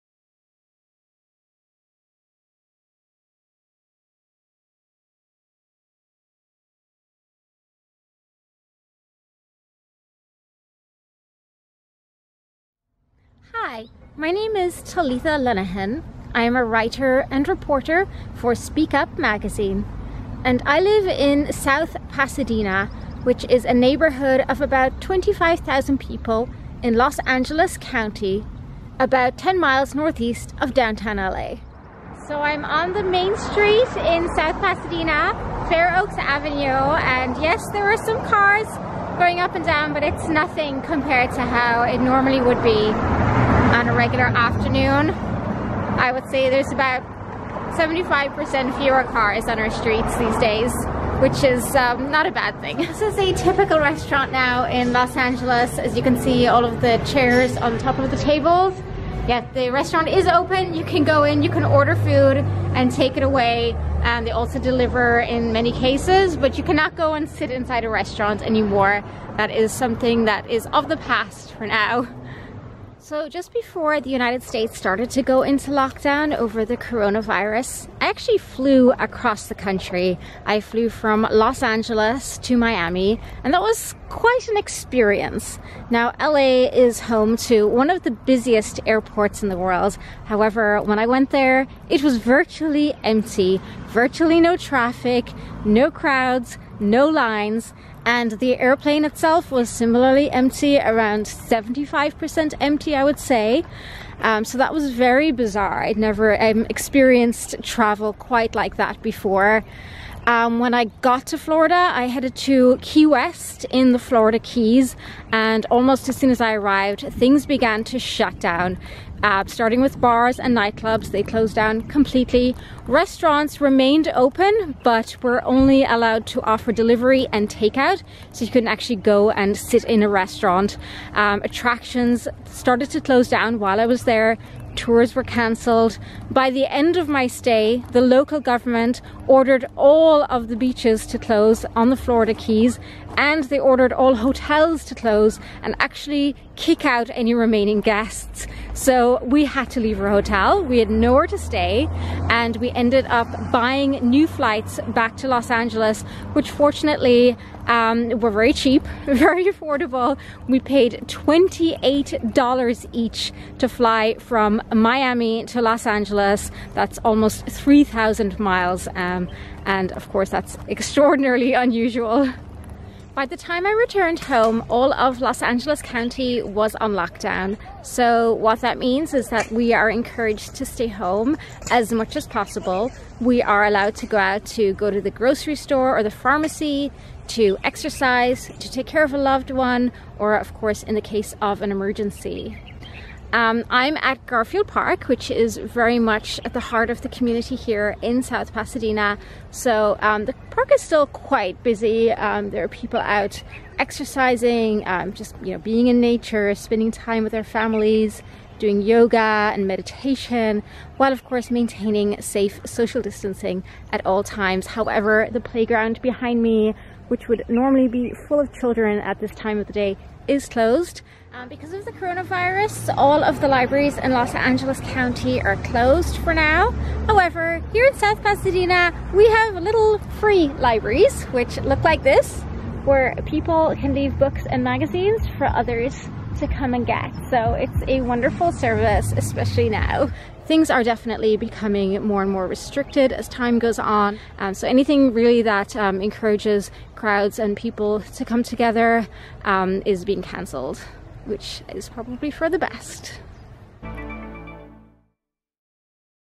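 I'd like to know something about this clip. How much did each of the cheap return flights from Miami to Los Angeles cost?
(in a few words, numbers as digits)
$28.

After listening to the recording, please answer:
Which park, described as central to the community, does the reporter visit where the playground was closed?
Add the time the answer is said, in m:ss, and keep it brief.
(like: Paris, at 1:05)
Garfield Park, at 3:14.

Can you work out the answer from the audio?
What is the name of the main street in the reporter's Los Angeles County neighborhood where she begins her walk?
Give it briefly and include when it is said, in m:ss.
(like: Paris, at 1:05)
Fair Oaks Avenue, at 0:35.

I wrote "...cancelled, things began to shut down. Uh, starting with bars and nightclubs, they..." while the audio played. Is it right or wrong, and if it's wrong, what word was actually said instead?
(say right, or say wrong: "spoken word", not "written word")
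wrong: "arrived", not "cancelled".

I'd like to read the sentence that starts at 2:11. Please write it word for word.
Um, attractions started to close down while I was there tours were cancelled.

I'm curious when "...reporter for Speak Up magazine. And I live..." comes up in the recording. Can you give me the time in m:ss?
0:17.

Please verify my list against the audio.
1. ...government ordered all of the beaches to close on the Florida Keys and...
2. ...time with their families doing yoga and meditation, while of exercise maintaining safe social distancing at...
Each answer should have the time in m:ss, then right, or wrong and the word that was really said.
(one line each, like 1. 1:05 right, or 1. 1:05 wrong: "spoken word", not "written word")
1. 2:18 right
2. 3:26 wrong: "course", not "exercise".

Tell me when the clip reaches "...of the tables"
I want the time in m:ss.
0:57.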